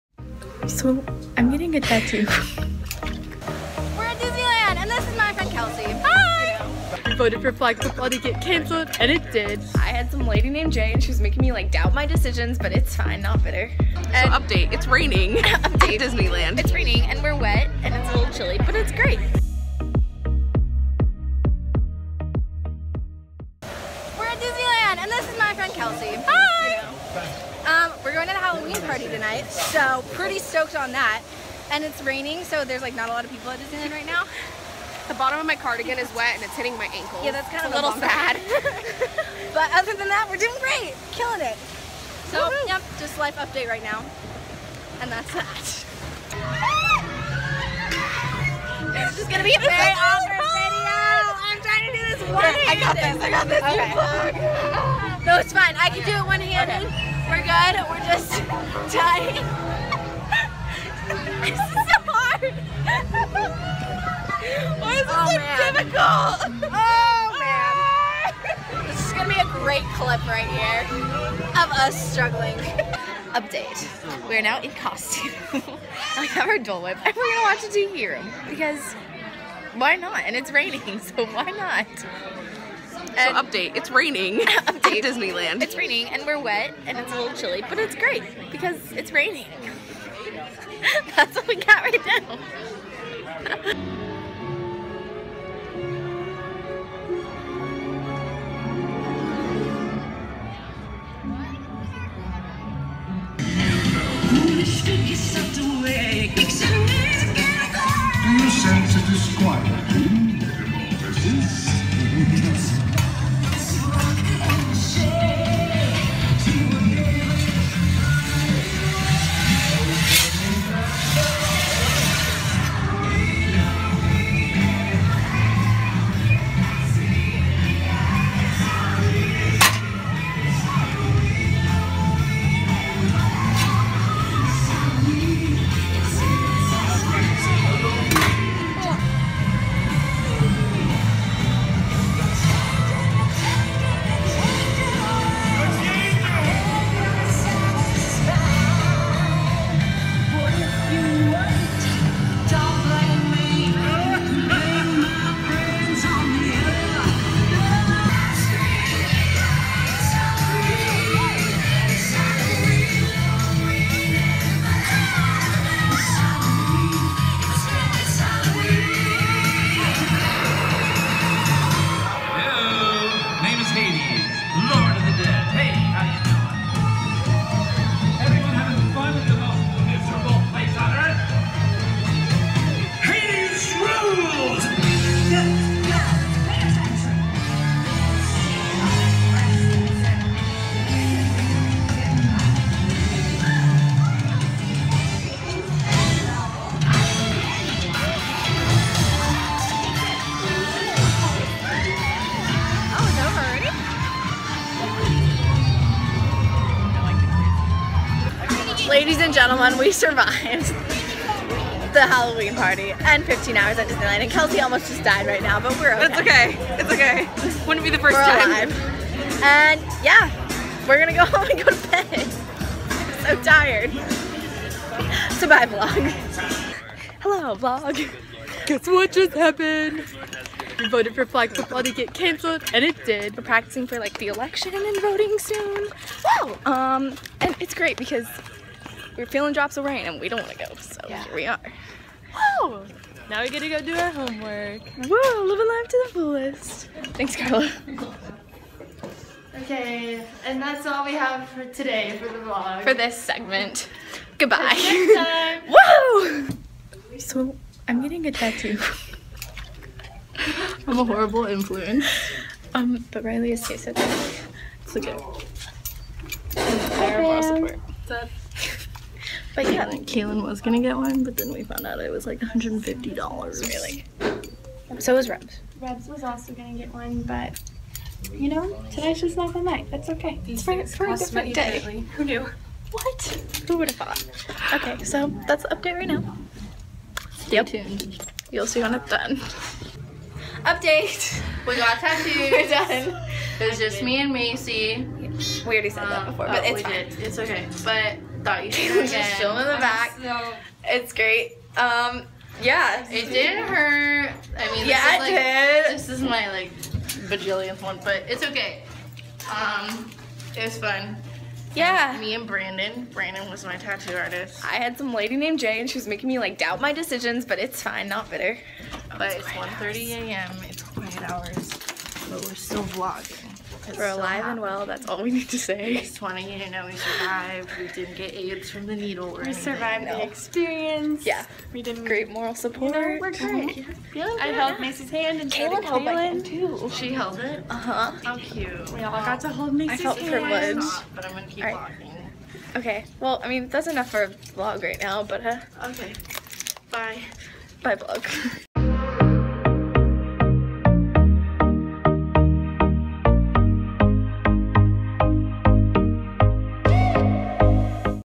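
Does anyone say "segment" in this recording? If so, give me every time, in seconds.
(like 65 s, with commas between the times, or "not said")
253 s.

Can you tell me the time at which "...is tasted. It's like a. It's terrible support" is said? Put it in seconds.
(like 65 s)
263 s.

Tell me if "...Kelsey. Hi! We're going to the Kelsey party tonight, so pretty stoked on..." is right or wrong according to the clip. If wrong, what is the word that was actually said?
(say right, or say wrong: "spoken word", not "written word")
wrong: "Halloween", not "Kelsey".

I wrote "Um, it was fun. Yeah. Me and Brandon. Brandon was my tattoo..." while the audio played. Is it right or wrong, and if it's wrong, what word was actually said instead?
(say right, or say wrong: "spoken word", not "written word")
right.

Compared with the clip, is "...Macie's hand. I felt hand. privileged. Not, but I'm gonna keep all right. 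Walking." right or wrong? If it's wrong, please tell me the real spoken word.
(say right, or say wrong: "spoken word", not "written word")
right.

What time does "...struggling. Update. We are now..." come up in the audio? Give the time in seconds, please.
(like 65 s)
72 s.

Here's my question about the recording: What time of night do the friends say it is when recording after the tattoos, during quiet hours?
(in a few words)
1:30 a.m.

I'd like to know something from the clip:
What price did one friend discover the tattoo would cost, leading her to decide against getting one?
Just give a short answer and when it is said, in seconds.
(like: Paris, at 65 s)
$150, at 272 s.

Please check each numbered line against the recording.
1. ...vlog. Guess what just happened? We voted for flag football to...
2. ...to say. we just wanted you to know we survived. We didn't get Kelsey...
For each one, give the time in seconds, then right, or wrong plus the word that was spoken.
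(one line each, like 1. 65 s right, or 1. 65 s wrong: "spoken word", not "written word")
1. 227 s right
2. 325 s wrong: "AIDS", not "Kelsey".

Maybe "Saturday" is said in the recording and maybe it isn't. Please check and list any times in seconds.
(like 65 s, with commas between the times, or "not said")
not said.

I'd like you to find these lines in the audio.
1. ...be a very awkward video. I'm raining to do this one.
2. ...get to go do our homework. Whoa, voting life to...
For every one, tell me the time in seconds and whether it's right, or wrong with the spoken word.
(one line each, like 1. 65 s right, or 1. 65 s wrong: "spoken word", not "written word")
1. 49 s wrong: "trying", not "raining"
2. 243 s wrong: "living", not "voting".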